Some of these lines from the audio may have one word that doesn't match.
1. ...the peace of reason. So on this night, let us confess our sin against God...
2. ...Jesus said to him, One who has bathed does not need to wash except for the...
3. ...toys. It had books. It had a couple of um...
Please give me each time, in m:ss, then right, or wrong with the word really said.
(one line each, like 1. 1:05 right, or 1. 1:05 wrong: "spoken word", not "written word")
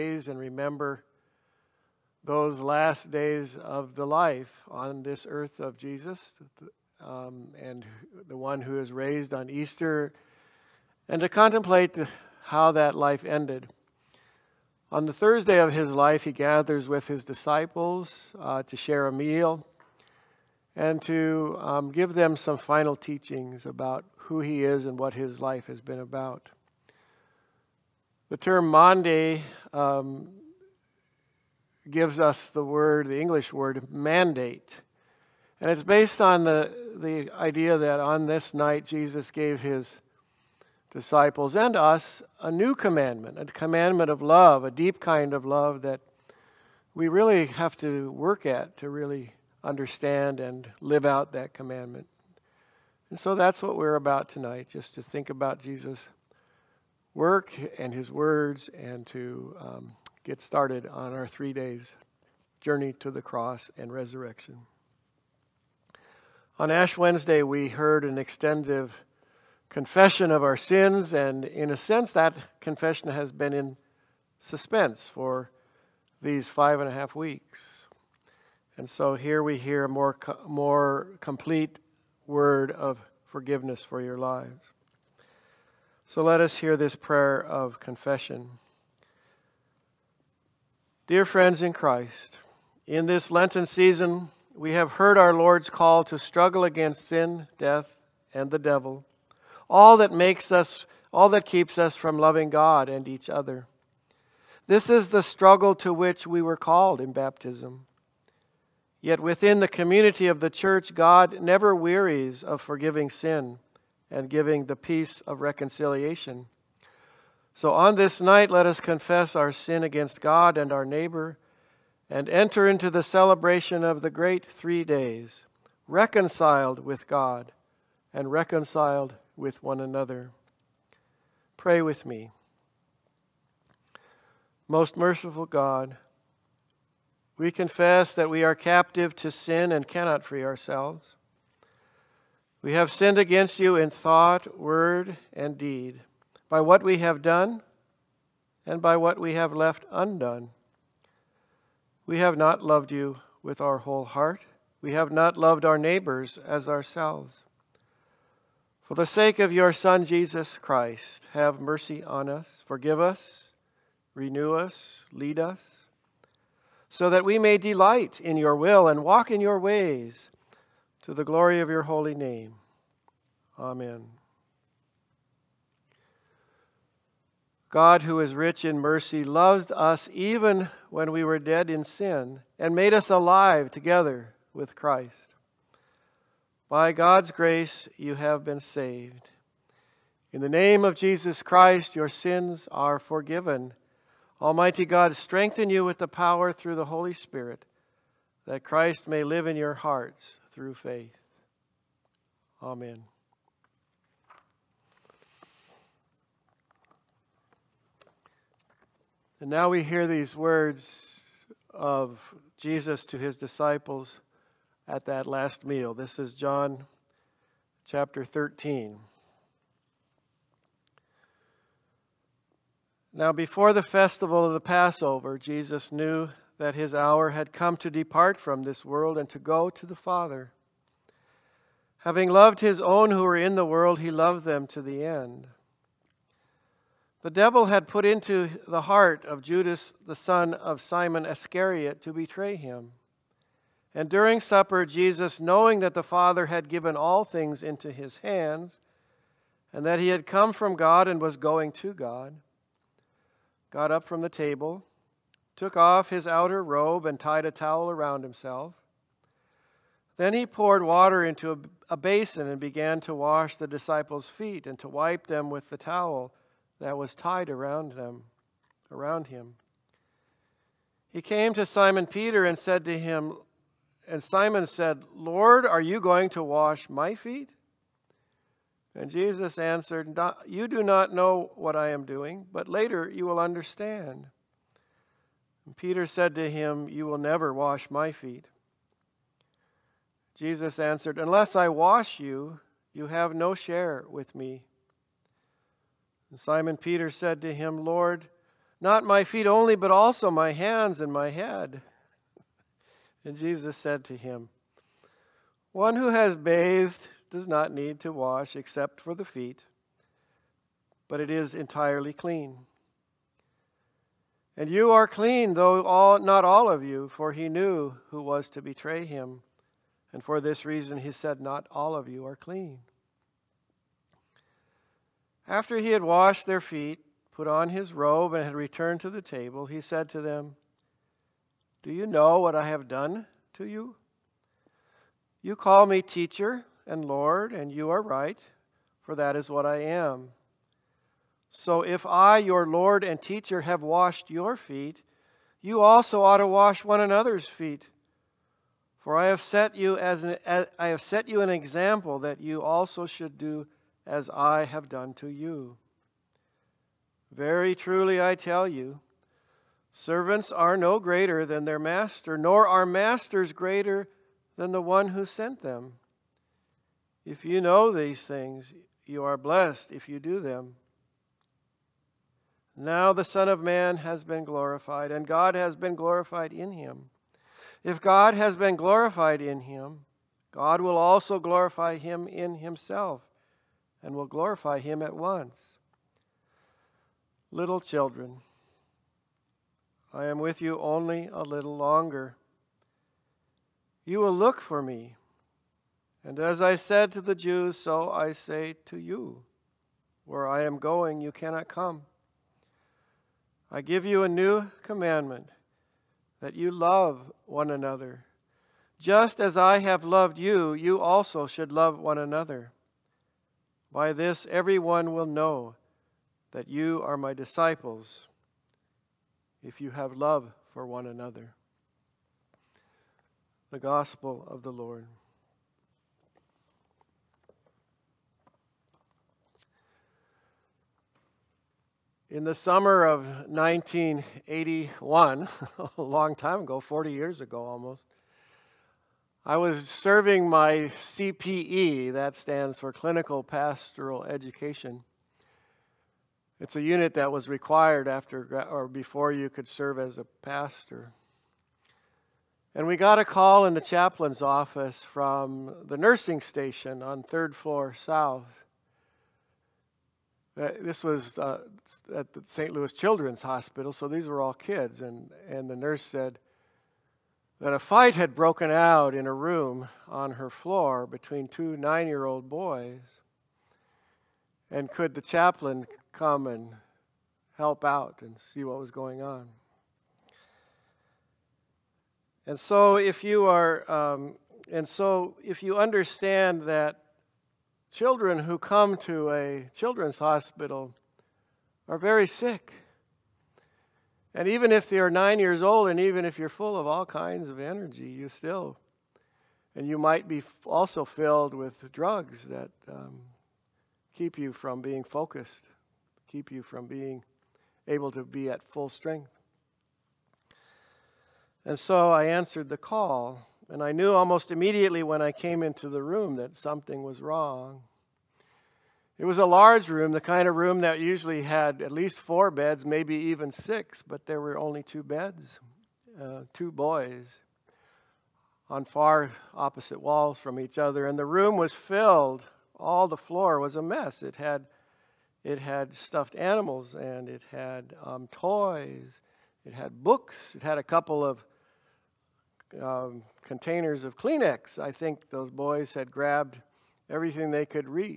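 1. 1:54 wrong: "reconciliation", not "reason"
2. 5:03 right
3. 8:58 right.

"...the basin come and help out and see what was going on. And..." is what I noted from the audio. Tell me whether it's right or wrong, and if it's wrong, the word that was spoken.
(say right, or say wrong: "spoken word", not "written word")
wrong: "chaplain", not "basin".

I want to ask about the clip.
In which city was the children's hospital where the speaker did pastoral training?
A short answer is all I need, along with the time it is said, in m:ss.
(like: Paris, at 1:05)
St. Louis, at 7:42.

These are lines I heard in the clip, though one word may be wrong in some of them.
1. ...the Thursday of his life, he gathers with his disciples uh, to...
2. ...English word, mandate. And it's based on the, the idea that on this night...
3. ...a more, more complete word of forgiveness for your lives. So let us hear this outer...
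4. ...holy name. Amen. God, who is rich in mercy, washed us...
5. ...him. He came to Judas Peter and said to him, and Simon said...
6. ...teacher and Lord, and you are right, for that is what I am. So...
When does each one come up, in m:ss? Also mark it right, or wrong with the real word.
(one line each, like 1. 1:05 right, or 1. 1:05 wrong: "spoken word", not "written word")
1. 0:15 right
2. 0:33 right
3. 1:19 wrong: "prayer", not "outer"
4. 2:51 wrong: "loved", not "washed"
5. 4:29 wrong: "Simon", not "Judas"
6. 5:36 right.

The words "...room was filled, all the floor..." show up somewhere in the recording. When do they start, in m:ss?
8:51.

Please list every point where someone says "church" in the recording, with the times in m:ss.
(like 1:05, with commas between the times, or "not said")
1:50.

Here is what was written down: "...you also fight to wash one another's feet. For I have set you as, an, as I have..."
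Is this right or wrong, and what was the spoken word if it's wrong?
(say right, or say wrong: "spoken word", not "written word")
wrong: "ought", not "fight".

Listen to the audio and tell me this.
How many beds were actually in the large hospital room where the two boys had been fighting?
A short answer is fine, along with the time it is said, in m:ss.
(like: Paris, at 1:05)
2, at 8:44.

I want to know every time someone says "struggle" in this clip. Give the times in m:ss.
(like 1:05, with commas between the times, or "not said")
1:36, 1:45.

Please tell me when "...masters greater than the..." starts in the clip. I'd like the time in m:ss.
6:02.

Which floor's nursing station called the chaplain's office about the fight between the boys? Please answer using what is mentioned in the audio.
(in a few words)
third floor south.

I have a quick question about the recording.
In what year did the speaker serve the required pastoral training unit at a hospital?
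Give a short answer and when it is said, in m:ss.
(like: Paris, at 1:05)
1981, at 7:13.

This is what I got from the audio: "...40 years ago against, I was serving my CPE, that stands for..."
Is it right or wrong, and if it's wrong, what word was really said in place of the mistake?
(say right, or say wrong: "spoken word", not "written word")
wrong: "almost", not "against".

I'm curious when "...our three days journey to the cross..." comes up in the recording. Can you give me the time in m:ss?
1:01.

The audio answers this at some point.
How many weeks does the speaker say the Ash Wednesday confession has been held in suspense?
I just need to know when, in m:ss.
1:16.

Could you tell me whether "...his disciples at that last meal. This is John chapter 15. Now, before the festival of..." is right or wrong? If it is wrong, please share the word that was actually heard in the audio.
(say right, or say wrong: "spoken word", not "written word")
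wrong: "13", not "15".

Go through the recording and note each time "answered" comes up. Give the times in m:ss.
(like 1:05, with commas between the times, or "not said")
4:39, 4:50, 8:32.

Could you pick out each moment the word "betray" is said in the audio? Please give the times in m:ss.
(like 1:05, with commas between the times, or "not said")
4:02, 5:18.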